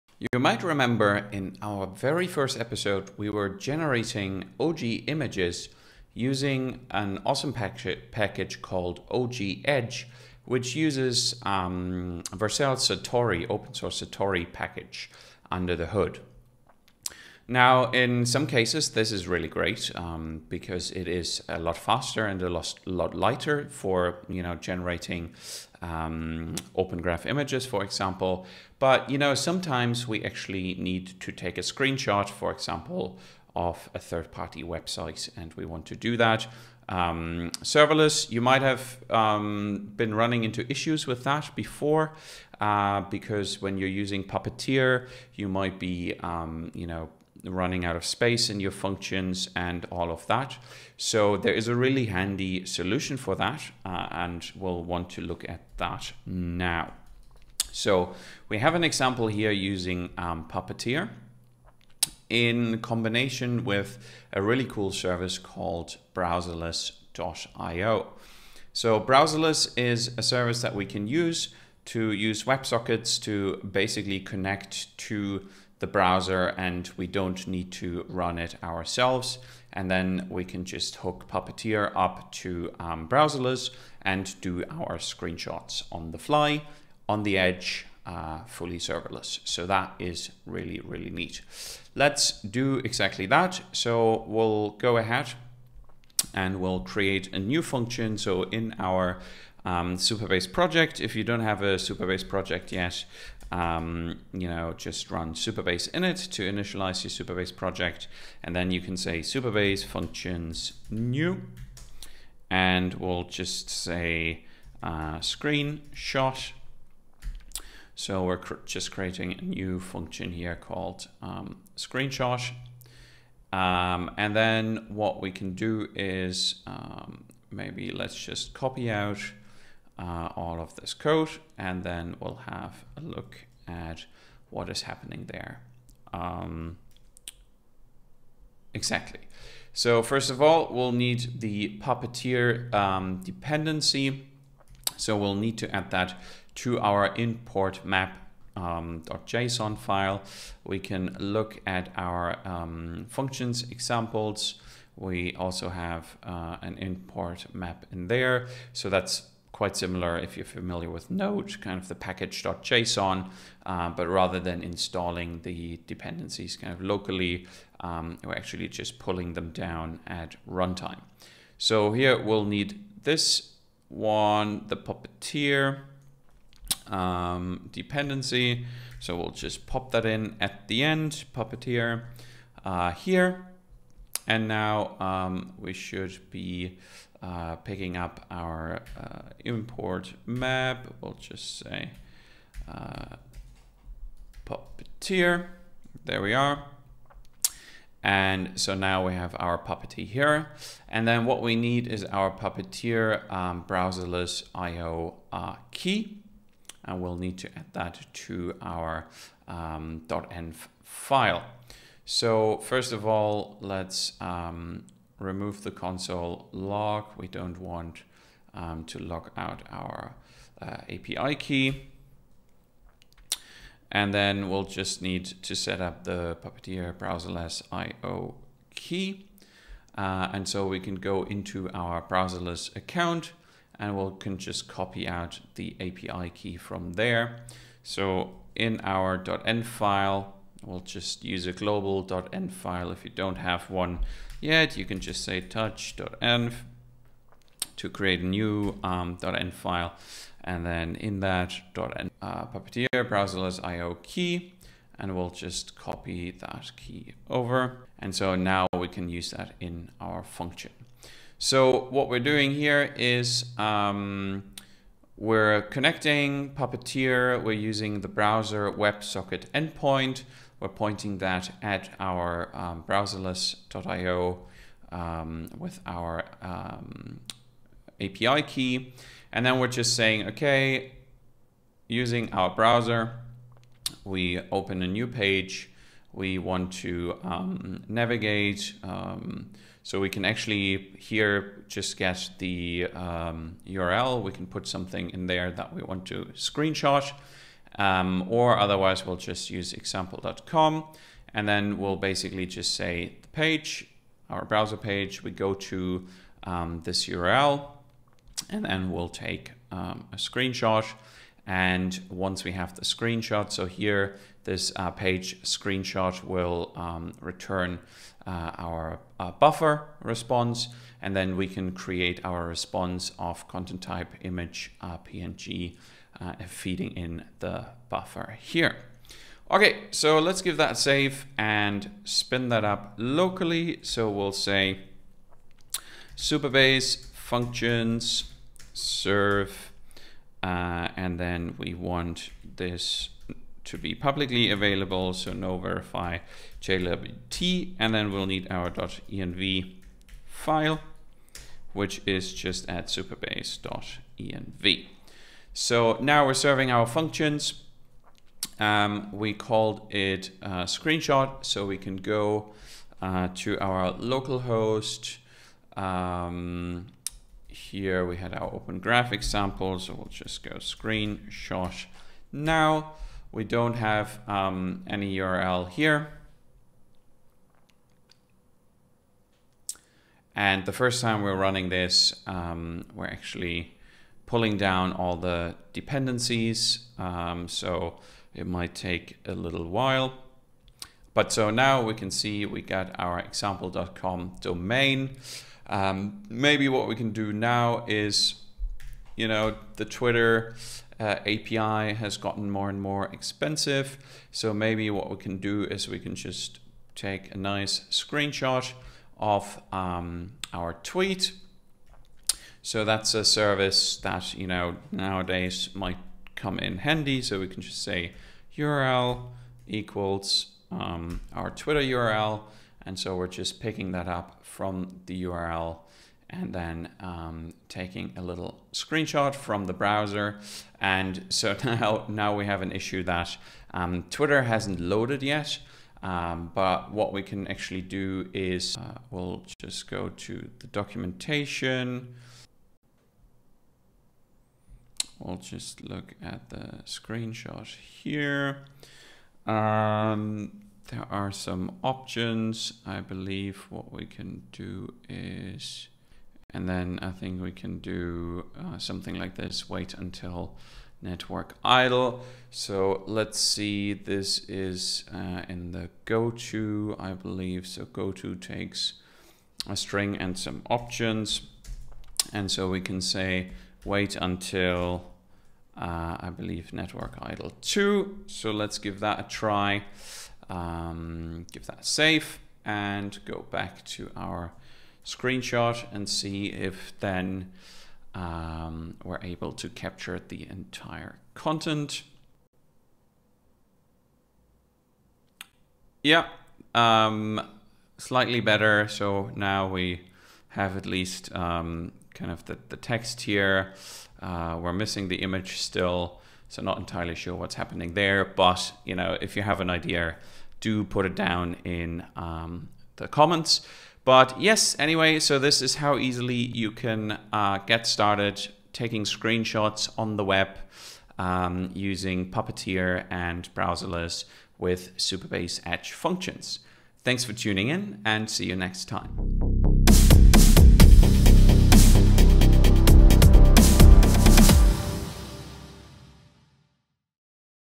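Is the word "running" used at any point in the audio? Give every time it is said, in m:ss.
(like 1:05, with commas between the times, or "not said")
0:40, 0:47, 6:21.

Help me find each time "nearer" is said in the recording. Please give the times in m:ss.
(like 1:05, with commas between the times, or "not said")
not said.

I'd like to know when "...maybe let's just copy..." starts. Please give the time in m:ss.
2:07.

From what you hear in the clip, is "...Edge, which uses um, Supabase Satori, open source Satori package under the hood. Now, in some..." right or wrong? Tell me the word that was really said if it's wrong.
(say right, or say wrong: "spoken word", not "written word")
wrong: "Vercel", not "Supabase".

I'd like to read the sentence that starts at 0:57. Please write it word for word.
So we have an example here using um, Puppeteer in combination with a really cool service called browserless.io.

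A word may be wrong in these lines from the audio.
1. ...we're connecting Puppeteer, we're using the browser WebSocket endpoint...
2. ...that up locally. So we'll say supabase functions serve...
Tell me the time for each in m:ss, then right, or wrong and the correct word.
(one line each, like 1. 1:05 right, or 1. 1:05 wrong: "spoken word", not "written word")
1. 4:25 right
2. 5:32 right.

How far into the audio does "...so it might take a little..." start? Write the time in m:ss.
6:27.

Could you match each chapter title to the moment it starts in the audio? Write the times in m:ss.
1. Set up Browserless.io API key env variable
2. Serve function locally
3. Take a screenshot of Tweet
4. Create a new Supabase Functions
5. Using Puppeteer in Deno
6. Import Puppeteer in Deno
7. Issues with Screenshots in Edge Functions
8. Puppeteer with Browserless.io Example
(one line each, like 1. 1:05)
1. 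3:20
2. 5:30
3. 6:40
4. 1:49
5. 4:40
6. 2:20
7. 0:38
8. 0:58.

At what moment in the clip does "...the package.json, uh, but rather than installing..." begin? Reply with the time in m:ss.
2:41.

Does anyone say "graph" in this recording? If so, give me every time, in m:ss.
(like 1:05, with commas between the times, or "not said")
0:27, 6:08.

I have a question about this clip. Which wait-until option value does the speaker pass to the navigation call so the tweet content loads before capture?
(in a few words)
networkidle2.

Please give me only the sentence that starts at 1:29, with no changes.
So that is really, really neat.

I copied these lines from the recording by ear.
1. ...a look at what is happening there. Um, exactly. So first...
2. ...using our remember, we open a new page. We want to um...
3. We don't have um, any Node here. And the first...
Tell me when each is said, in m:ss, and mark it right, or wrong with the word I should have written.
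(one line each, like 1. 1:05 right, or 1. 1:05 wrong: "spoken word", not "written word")
1. 2:12 right
2. 4:41 wrong: "browser", not "remember"
3. 6:13 wrong: "URL", not "Node".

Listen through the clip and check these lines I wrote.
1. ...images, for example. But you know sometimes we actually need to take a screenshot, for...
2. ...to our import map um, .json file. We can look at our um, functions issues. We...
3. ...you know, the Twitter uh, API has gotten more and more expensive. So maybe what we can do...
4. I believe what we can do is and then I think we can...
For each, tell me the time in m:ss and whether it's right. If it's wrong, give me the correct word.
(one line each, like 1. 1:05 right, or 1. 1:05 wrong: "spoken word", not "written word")
1. 0:27 right
2. 2:26 wrong: "examples", not "issues"
3. 6:39 right
4. 7:32 right.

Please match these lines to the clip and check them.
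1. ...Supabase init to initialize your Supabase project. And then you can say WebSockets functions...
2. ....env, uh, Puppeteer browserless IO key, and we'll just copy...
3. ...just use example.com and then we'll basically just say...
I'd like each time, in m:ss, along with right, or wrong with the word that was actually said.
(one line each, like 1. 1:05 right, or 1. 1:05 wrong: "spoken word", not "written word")
1. 1:45 wrong: "Supabase", not "WebSockets"
2. 4:11 right
3. 4:59 right.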